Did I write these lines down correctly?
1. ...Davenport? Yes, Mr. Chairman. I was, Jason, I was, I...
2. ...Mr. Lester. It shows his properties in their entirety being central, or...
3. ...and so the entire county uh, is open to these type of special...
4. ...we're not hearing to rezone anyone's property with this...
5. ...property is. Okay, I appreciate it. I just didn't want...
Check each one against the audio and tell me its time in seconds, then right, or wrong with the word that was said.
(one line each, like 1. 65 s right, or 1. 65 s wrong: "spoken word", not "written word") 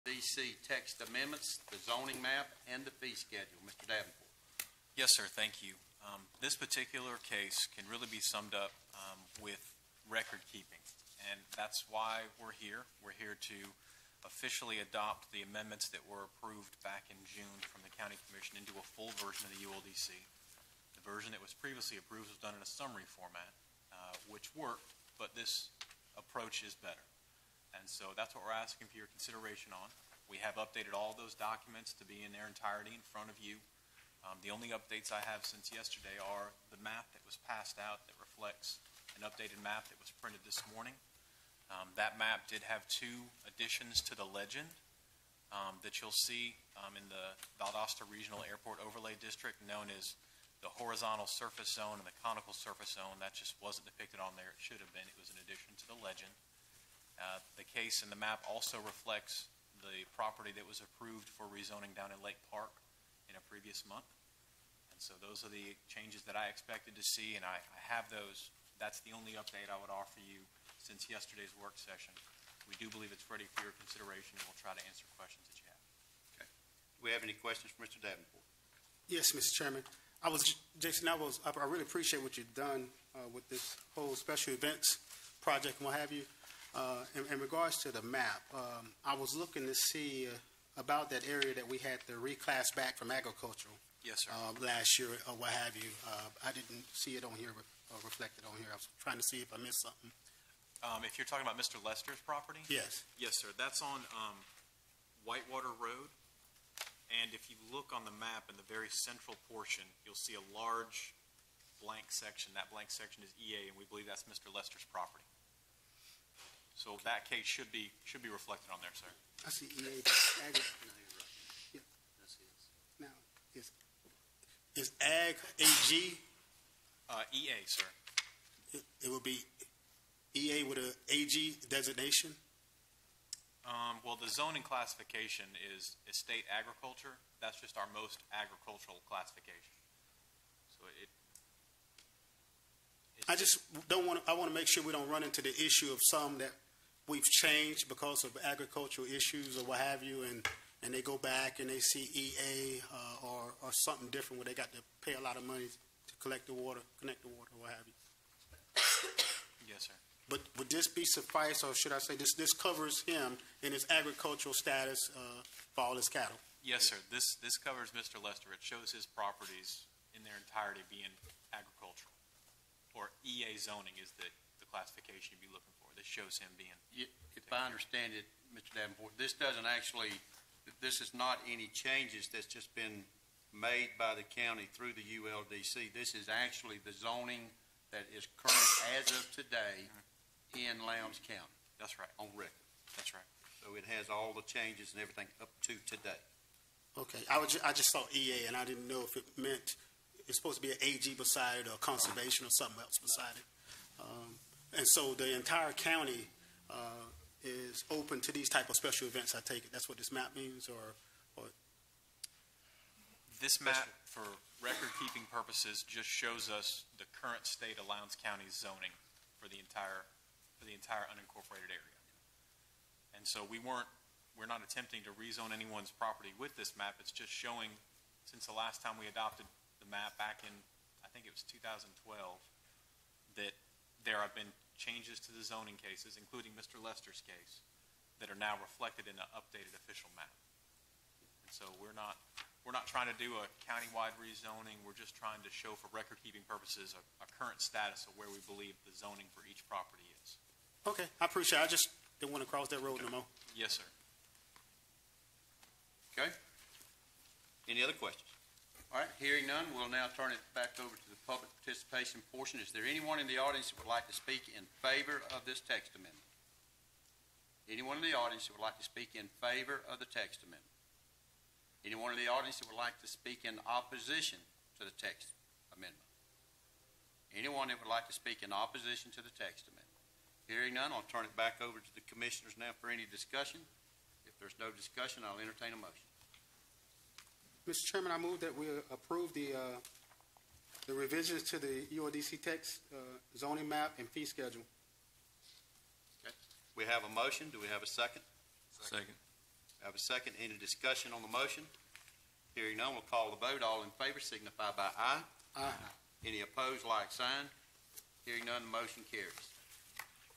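1. 78 s right
2. 167 s wrong: "agricultural", not "central"
3. 204 s right
4. 224 s wrong: "attempting", not "hearing"
5. 249 s right.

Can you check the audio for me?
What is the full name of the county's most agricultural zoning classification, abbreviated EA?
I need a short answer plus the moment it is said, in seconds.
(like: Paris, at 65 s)
estate agriculture, at 136 s.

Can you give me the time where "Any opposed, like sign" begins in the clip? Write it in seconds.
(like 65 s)
306 s.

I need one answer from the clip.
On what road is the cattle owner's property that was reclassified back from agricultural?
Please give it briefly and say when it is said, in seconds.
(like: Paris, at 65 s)
Whitewater Road, at 105 s.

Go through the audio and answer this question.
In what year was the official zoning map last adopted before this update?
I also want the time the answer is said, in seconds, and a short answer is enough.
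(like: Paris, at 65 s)
2012, at 231 s.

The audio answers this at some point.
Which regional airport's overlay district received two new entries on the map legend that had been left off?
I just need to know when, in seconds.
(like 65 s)
47 s.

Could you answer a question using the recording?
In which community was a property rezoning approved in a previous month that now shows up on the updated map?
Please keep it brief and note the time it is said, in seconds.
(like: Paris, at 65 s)
Lake Park, at 62 s.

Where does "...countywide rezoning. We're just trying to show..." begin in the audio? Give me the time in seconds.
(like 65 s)
243 s.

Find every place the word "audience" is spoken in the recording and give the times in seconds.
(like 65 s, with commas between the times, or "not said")
263 s, 268 s, 272 s.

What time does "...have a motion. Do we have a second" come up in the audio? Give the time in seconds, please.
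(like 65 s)
296 s.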